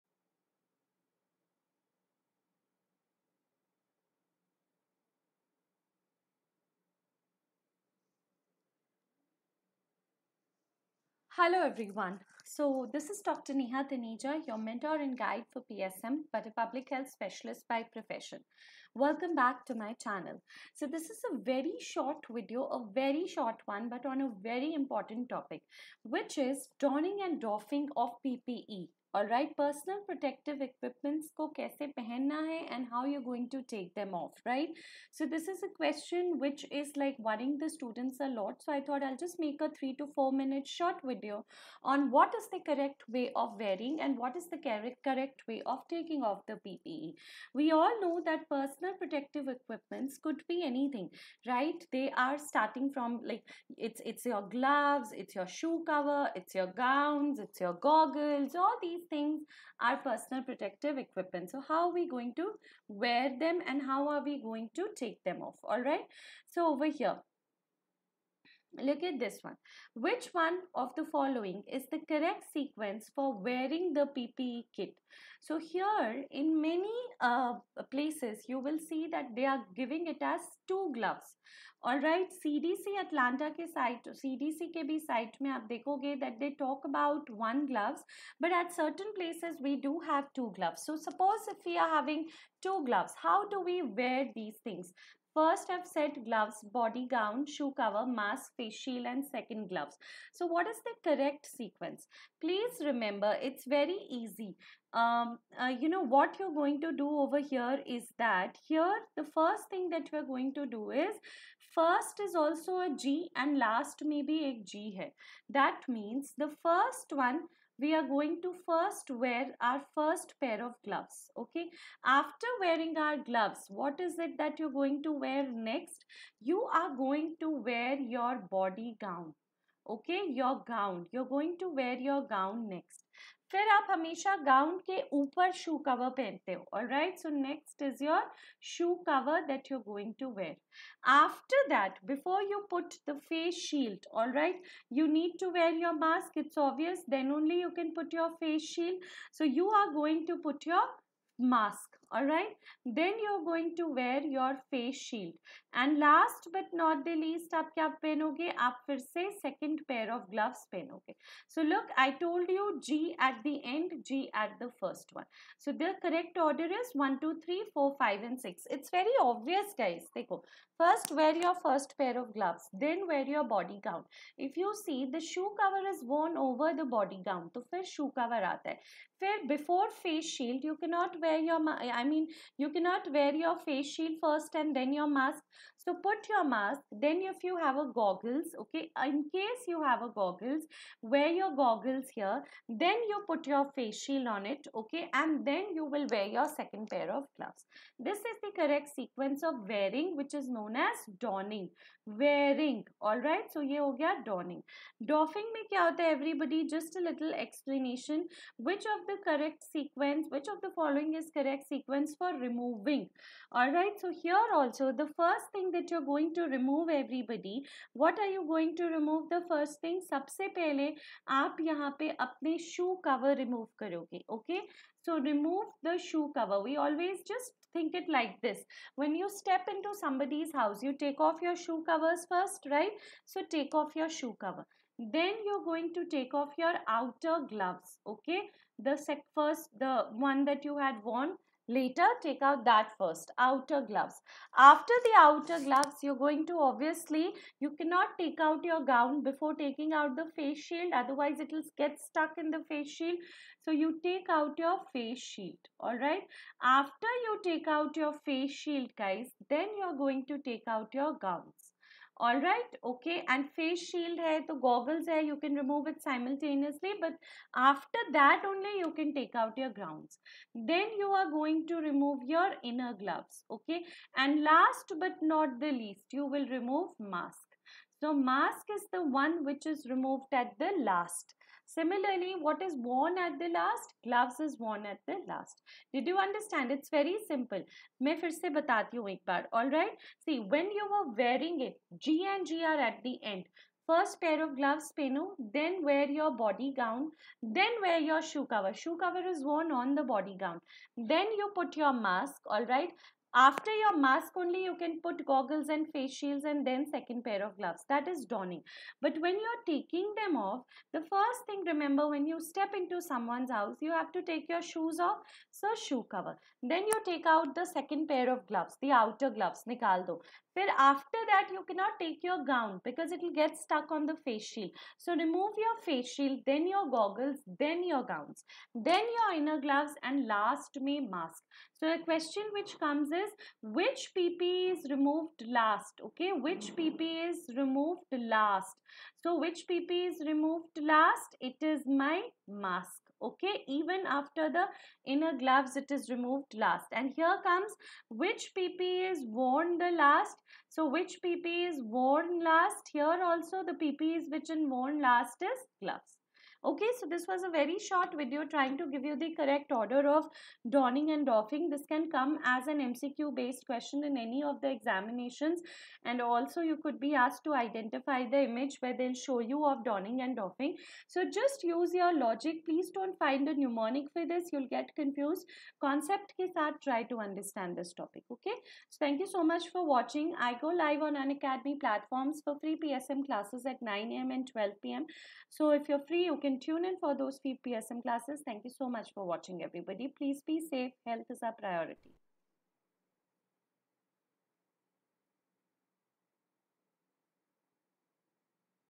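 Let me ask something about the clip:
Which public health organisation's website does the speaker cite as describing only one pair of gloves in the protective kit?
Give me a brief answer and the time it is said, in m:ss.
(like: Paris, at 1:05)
CDC Atlanta, at 1:22.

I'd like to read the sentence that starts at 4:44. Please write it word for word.
Gloves is worn at the last.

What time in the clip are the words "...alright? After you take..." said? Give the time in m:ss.
4:15.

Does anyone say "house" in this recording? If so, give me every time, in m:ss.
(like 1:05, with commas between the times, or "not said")
3:50, 5:13.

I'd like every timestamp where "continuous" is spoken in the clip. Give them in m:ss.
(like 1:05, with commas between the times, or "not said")
not said.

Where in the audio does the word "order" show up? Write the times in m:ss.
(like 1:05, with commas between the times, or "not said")
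2:46, 5:59.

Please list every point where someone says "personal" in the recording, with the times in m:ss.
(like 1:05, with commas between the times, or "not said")
0:29, 0:48, 0:59.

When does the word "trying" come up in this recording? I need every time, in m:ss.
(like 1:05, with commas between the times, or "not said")
5:58.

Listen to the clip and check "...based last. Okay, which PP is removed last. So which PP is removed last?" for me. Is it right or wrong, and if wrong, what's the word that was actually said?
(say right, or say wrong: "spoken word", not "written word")
wrong: "removed", not "based".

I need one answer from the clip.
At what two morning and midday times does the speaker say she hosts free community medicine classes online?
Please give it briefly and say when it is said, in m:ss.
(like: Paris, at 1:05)
9 a.m. and 12 p.m., at 6:23.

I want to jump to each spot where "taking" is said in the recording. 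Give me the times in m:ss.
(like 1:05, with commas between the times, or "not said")
0:45, 4:09, 5:09.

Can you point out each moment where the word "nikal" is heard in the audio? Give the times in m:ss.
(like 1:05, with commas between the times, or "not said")
5:19.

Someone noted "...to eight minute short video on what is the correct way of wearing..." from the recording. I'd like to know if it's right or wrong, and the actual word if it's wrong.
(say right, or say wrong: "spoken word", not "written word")
wrong: "four", not "eight".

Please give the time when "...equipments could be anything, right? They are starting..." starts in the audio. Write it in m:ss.
0:49.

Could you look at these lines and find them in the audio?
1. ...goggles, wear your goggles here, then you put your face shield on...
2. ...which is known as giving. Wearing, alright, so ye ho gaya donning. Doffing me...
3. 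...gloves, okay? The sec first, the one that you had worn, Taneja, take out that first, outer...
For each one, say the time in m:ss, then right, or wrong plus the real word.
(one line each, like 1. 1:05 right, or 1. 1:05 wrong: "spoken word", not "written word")
1. 3:10 right
2. 3:20 wrong: "donning", not "giving"
3. 3:57 wrong: "Later", not "Taneja".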